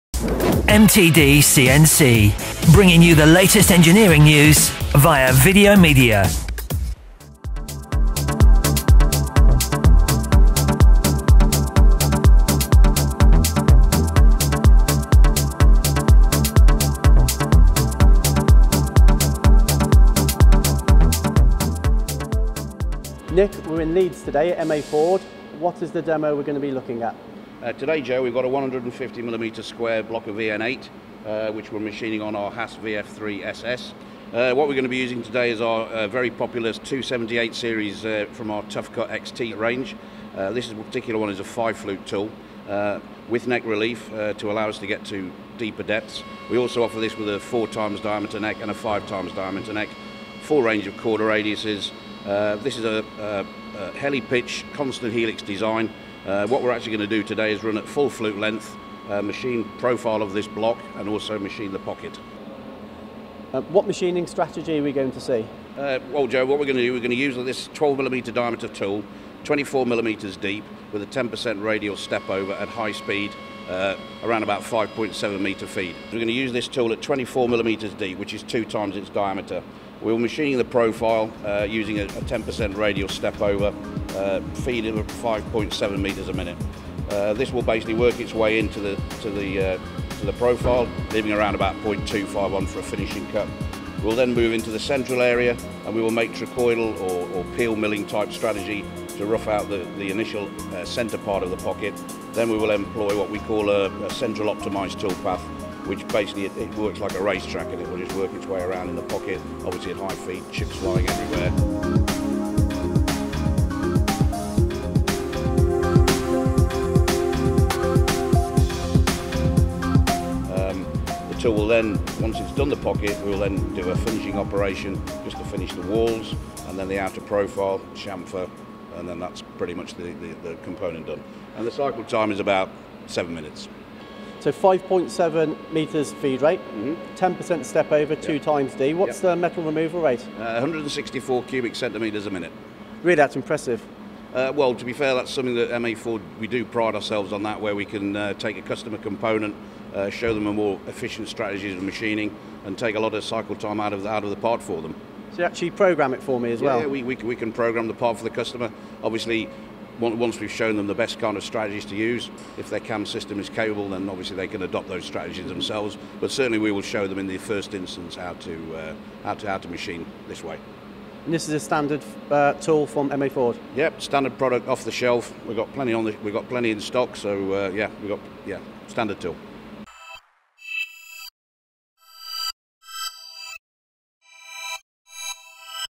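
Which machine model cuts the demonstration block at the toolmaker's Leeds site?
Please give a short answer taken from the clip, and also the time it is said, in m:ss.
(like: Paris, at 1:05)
Haas VF3 SS, at 0:32.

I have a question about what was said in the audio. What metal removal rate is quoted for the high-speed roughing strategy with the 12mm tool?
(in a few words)
164 cubic centimetres a minute.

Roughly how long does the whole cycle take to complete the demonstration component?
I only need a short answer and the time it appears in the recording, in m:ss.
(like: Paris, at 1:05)
About 7 minutes, at 2:13.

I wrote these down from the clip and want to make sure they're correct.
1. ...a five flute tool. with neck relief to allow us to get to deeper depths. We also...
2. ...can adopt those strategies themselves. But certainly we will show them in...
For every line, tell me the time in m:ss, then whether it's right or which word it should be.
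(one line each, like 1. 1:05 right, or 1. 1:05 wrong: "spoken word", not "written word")
1. 0:41 right
2. 2:44 right.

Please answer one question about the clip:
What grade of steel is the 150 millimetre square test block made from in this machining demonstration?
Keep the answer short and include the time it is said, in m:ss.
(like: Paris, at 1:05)
EN8, at 0:30.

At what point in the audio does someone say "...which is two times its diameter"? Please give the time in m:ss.
1:18.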